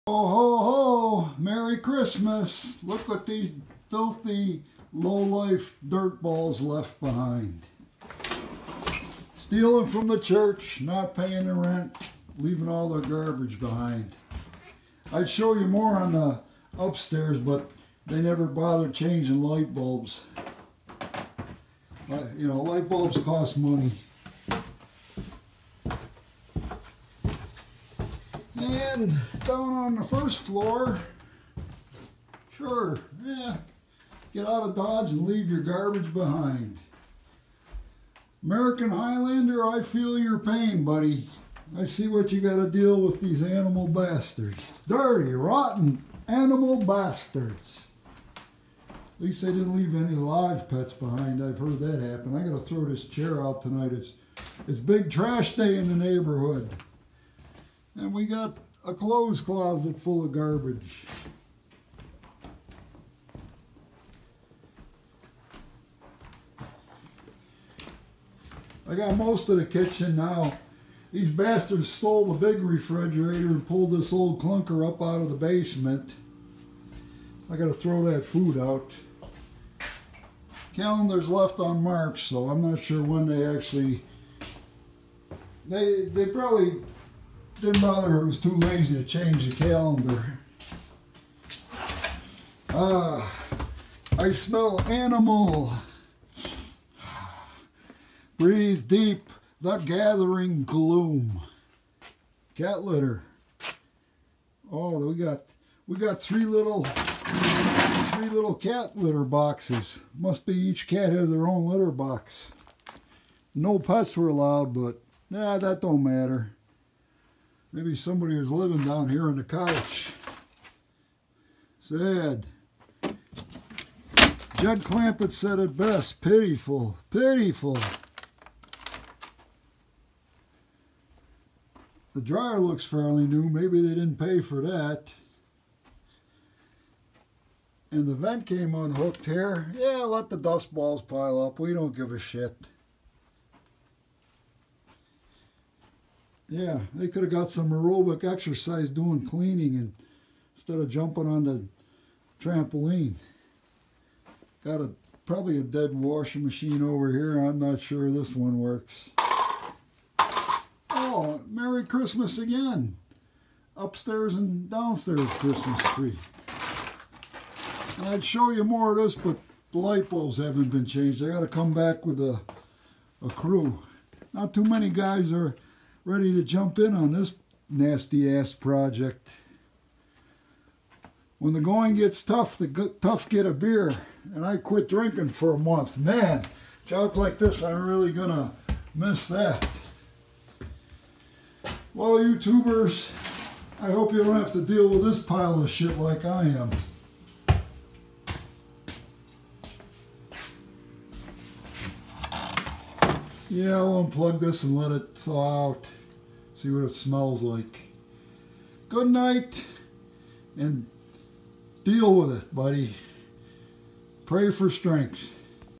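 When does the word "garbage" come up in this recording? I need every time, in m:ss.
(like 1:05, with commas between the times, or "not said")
0:13, 0:35, 1:00.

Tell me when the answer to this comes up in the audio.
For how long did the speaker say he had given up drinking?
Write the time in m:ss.
3:05.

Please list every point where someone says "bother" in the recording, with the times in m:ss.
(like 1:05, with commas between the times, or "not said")
0:18, 1:27.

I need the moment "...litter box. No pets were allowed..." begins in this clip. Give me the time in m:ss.
1:51.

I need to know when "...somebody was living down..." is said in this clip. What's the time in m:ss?
1:57.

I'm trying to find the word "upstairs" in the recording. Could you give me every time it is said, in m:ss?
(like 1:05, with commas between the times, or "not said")
0:16, 2:43.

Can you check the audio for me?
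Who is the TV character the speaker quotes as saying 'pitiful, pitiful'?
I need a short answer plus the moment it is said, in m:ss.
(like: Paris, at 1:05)
Jed Clampett, at 2:04.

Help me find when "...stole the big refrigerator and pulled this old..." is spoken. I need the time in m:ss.
1:11.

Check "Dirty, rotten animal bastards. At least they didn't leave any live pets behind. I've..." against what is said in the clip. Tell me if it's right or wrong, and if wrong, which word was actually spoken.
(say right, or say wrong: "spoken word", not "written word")
right.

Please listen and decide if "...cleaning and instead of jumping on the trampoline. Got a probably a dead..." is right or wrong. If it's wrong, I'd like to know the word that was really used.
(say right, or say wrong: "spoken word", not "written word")
right.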